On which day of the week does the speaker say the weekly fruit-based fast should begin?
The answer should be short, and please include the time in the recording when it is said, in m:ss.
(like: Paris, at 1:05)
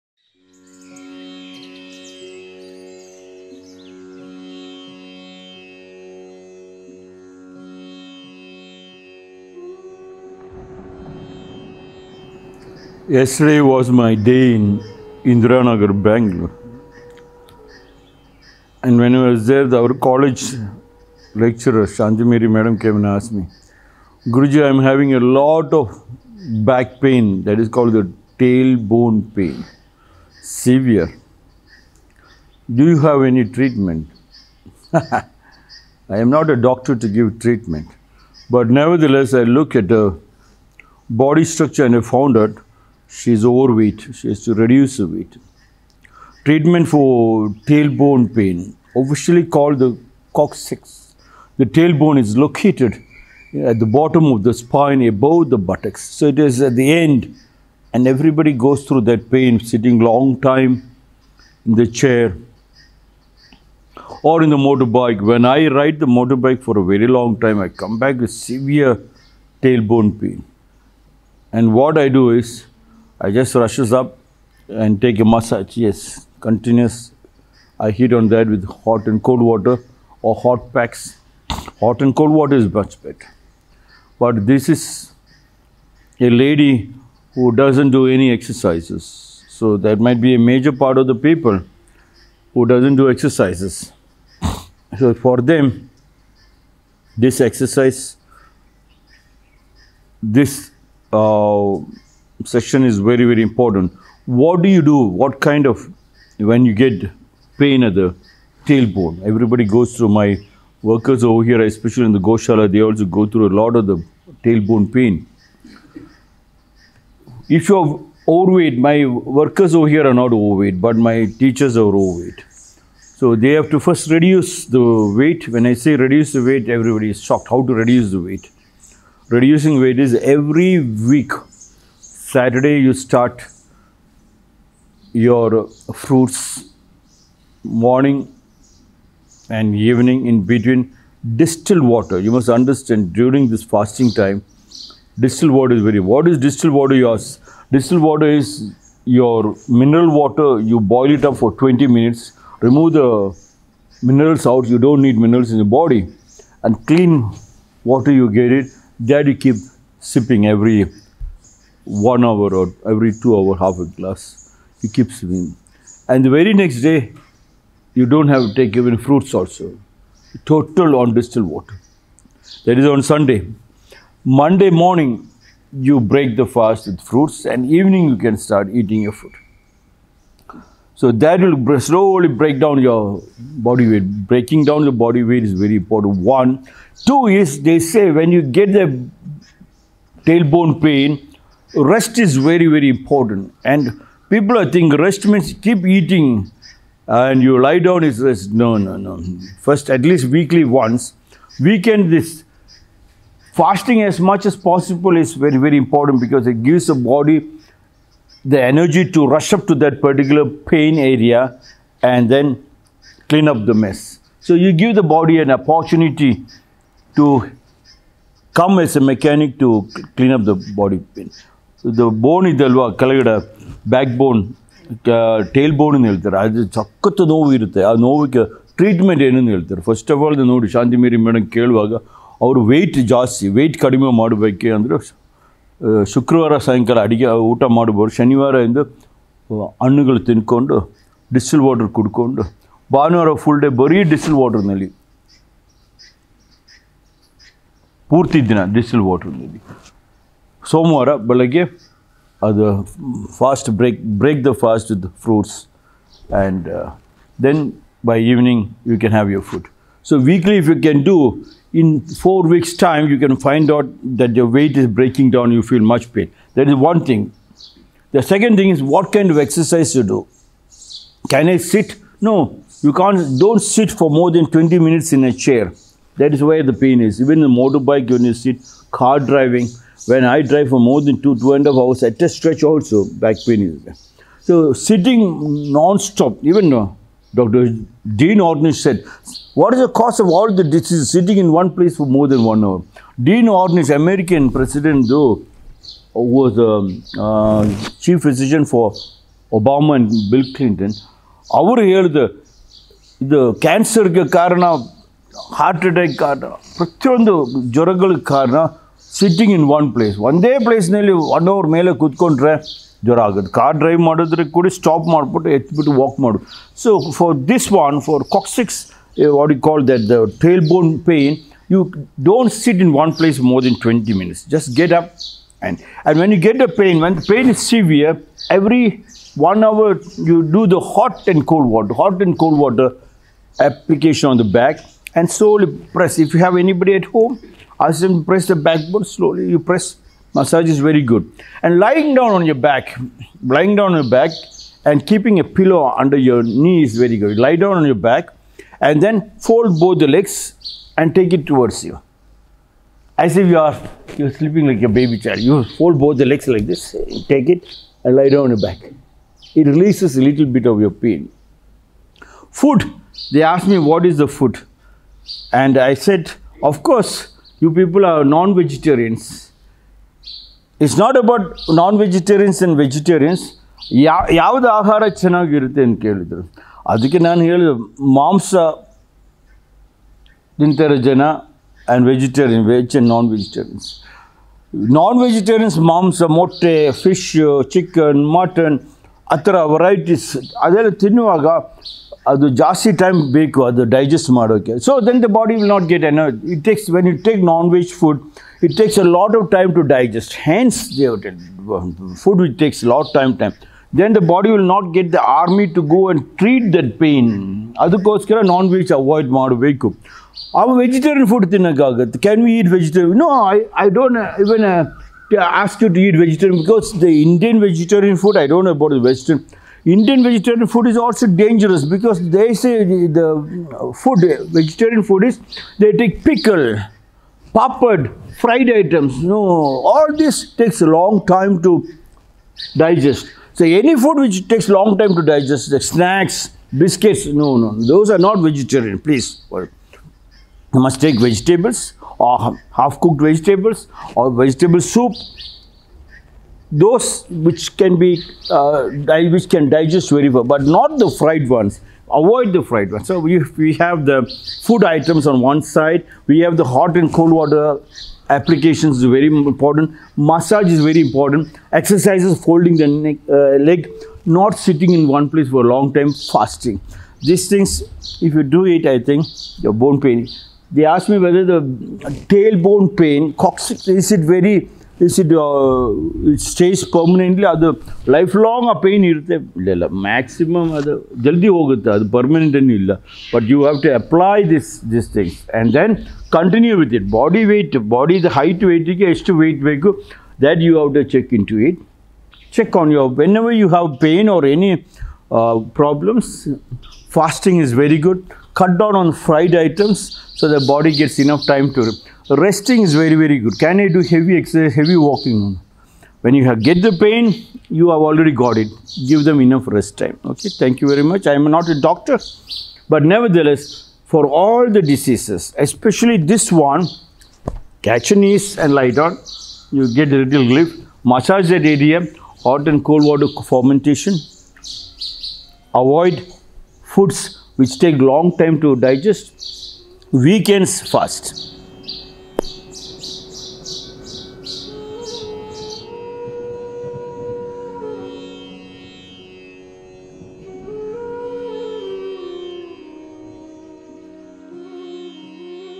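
Saturday, at 2:12.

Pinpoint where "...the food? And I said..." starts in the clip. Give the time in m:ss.
6:04.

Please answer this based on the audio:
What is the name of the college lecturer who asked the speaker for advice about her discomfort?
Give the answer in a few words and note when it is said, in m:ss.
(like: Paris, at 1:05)
Shanti Mary, at 0:21.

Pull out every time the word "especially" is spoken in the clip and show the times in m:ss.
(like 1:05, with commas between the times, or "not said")
1:51, 8:35.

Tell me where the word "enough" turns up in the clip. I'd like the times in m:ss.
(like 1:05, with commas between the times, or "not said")
8:21, 8:29.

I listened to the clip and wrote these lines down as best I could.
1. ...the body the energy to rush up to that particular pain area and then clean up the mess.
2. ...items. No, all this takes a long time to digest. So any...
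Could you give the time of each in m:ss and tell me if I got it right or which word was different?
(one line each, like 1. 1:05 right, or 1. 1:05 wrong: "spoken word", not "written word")
1. 3:26 right
2. 7:08 right.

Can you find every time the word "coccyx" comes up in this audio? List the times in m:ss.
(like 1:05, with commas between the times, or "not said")
0:50, 7:53.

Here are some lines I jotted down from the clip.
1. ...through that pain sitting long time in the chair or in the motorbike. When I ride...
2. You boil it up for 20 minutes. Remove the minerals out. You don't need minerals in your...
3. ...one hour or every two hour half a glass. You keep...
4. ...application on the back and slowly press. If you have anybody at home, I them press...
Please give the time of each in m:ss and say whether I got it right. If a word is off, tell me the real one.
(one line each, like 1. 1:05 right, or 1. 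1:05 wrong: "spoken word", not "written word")
1. 0:58 right
2. 2:30 right
3. 2:41 right
4. 5:33 right.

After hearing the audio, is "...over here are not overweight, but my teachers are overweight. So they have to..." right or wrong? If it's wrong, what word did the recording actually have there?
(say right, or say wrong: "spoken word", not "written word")
right.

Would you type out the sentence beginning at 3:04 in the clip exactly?
Breaking down the body weight is very important.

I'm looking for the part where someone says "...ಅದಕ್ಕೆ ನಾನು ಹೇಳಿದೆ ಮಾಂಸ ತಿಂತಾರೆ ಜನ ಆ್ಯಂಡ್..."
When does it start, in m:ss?
6:16.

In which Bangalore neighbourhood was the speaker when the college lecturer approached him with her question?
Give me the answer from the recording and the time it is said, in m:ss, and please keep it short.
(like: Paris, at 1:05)
Indiranagar, at 0:15.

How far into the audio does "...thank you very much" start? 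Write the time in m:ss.
8:30.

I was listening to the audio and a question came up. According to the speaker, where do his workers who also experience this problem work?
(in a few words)
Goshala.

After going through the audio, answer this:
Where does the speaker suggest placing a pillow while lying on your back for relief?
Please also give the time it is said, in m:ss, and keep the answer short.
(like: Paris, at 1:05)
under your knee, at 5:46.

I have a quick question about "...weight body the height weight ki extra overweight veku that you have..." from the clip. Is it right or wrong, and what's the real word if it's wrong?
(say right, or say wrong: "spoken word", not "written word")
wrong: "weight", not "overweight".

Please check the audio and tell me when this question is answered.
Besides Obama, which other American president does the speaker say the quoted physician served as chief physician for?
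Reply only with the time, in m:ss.
5:00.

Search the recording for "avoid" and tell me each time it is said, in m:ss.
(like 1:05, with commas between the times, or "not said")
7:32, 8:45.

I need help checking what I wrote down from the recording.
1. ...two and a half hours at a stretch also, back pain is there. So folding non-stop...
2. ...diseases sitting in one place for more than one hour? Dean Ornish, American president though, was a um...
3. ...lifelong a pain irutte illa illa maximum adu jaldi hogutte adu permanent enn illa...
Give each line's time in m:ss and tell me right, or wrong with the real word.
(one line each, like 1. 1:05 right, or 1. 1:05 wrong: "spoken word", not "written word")
1. 4:41 wrong: "sitting", not "folding"
2. 4:50 right
3. 7:58 right.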